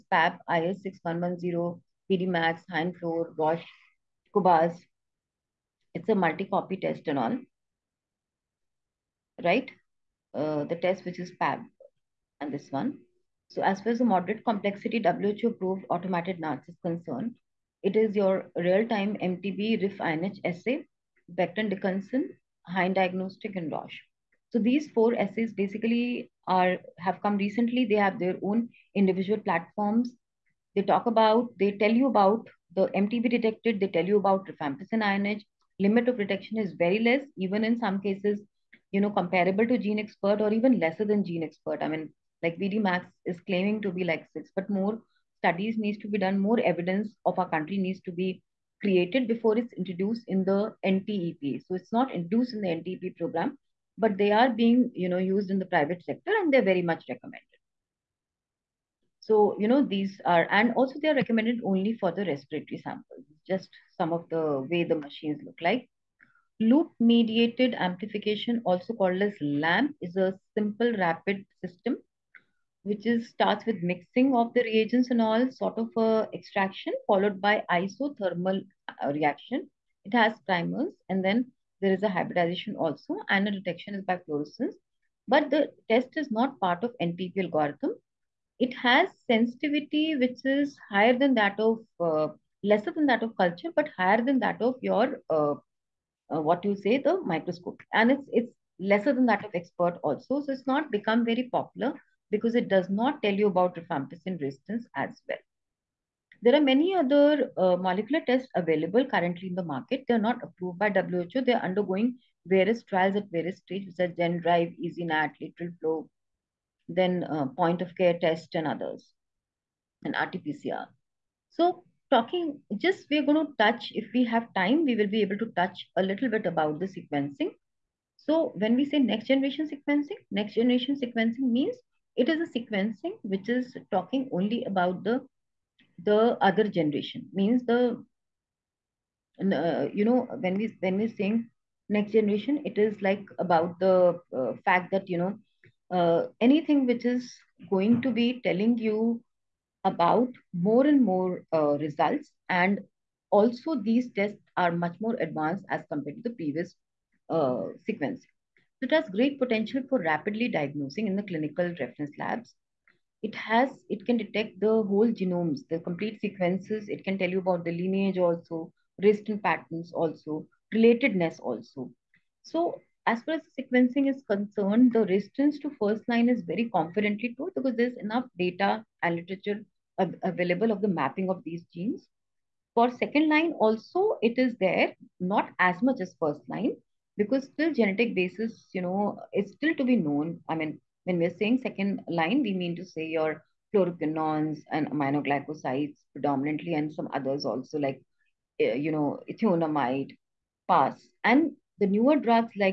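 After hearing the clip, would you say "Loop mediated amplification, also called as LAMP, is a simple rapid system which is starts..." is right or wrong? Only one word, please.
right.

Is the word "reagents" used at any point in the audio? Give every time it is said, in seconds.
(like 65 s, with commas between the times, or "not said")
74 s.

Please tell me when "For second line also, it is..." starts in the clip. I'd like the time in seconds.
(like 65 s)
182 s.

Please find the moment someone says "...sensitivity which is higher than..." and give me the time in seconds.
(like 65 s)
89 s.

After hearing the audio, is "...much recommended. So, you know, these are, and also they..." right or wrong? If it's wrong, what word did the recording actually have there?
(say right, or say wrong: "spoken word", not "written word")
right.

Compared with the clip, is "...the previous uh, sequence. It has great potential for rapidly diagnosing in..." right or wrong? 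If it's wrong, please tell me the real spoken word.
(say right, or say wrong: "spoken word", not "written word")
right.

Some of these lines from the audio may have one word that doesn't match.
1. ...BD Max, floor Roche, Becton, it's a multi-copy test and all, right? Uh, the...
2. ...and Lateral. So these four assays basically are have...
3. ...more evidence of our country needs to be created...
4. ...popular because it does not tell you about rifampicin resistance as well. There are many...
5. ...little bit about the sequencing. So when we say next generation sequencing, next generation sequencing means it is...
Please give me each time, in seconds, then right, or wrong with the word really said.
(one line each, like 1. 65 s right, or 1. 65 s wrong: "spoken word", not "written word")
1. 2 s wrong: "COBAS", not "Becton"
2. 23 s wrong: "Roche", not "Lateral"
3. 46 s right
4. 101 s right
5. 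126 s right.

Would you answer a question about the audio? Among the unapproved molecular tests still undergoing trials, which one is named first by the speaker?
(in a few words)
Genedrive.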